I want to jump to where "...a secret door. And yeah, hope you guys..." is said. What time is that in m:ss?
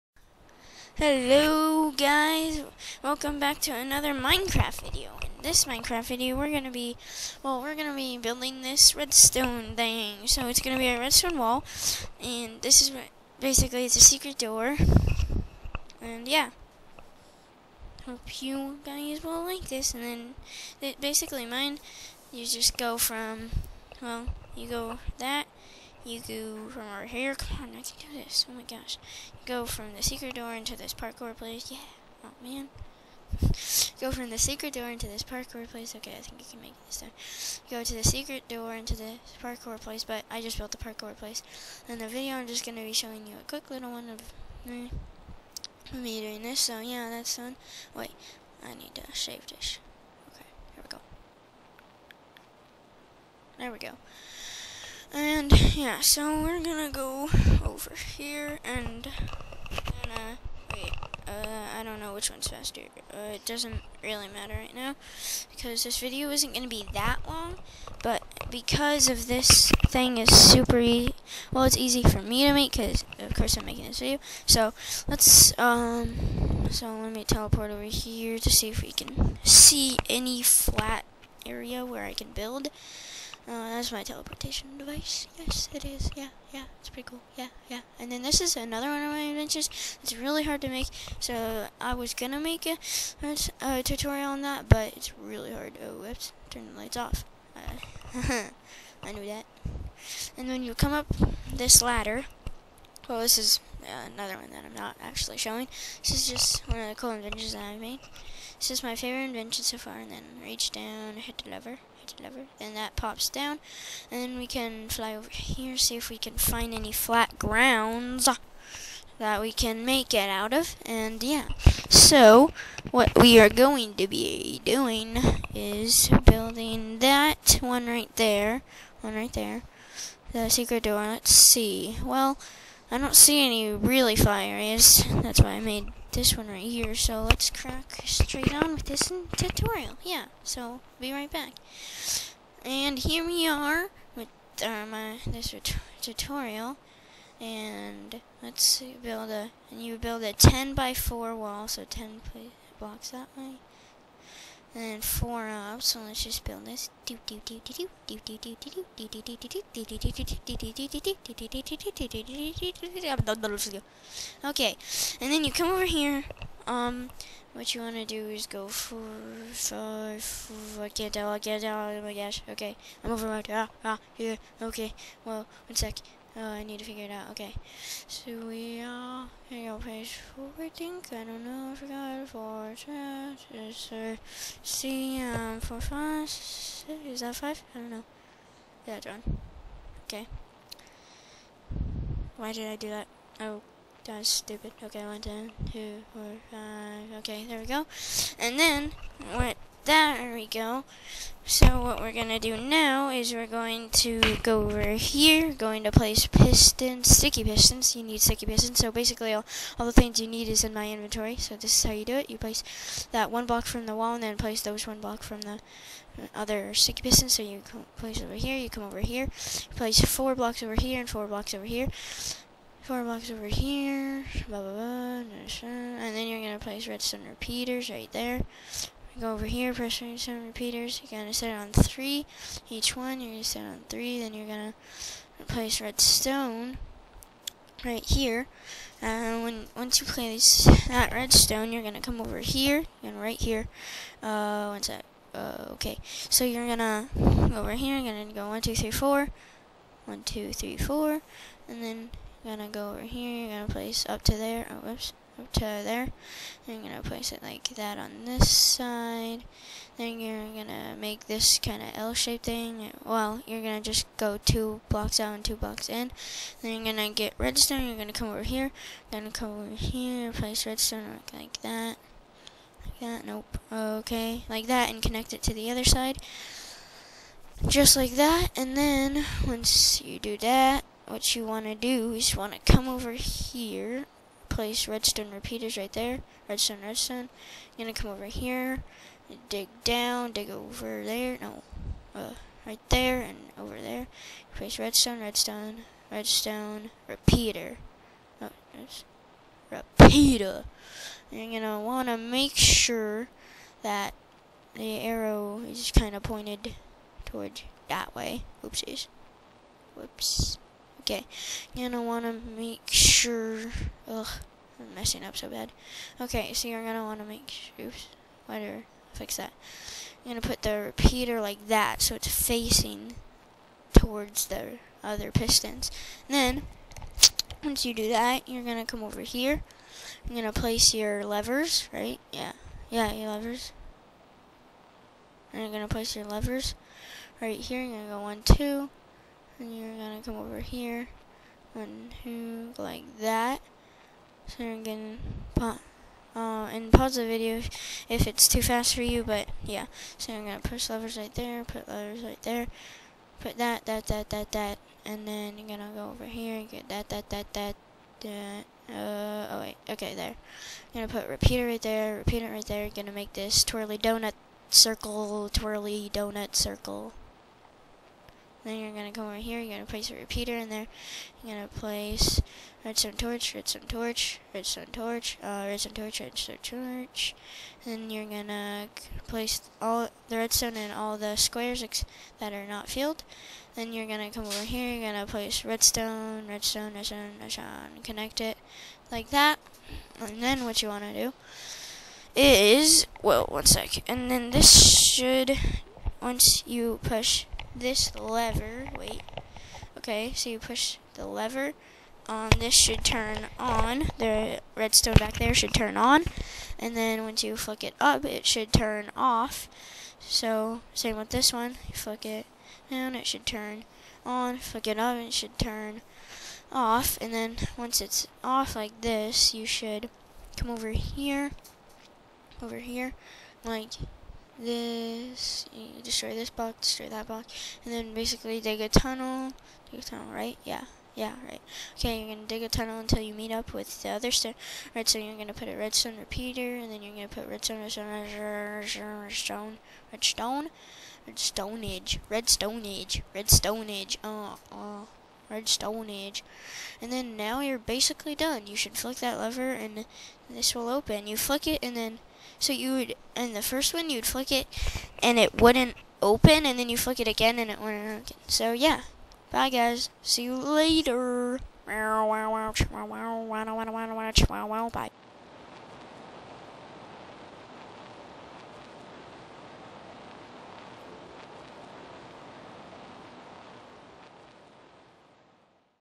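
0:13.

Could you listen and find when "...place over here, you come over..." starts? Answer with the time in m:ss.
3:37.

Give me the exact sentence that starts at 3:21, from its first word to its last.
So what we're going to do now is we're going to go over here, going to place pistons, sticky pistons.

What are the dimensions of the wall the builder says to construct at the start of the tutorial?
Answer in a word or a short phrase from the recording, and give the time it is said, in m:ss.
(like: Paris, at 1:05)
10 by 4, at 2:30.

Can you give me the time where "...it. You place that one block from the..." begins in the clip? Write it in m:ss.
3:32.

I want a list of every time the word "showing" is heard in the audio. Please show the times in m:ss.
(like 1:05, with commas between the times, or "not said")
0:42, 1:45.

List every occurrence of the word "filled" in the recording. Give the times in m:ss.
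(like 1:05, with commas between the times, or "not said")
6:22.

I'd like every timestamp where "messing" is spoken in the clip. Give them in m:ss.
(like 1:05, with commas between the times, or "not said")
5:14.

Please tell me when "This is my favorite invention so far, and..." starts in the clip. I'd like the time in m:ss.
1:48.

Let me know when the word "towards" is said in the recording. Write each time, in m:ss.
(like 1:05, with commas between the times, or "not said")
5:07, 5:23.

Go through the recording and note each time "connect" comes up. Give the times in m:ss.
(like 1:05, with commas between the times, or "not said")
4:35, 6:28.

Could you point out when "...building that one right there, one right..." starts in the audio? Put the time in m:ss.
2:06.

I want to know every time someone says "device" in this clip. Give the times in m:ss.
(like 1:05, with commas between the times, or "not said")
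1:24.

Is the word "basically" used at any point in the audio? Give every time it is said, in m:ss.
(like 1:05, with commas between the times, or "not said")
0:13, 0:21, 3:28, 7:08, 7:27.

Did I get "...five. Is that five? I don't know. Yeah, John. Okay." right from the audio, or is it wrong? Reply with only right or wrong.
wrong.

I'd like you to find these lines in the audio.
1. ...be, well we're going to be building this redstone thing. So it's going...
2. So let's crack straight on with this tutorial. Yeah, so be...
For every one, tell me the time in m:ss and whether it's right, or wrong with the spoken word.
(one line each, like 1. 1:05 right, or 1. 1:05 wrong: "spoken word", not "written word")
1. 0:06 right
2. 2:16 right.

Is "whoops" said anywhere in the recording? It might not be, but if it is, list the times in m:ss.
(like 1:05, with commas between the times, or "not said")
1:36, 4:14, 5:09.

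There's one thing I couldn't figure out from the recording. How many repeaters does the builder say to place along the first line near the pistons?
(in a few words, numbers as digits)
7.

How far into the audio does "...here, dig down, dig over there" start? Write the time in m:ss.
4:48.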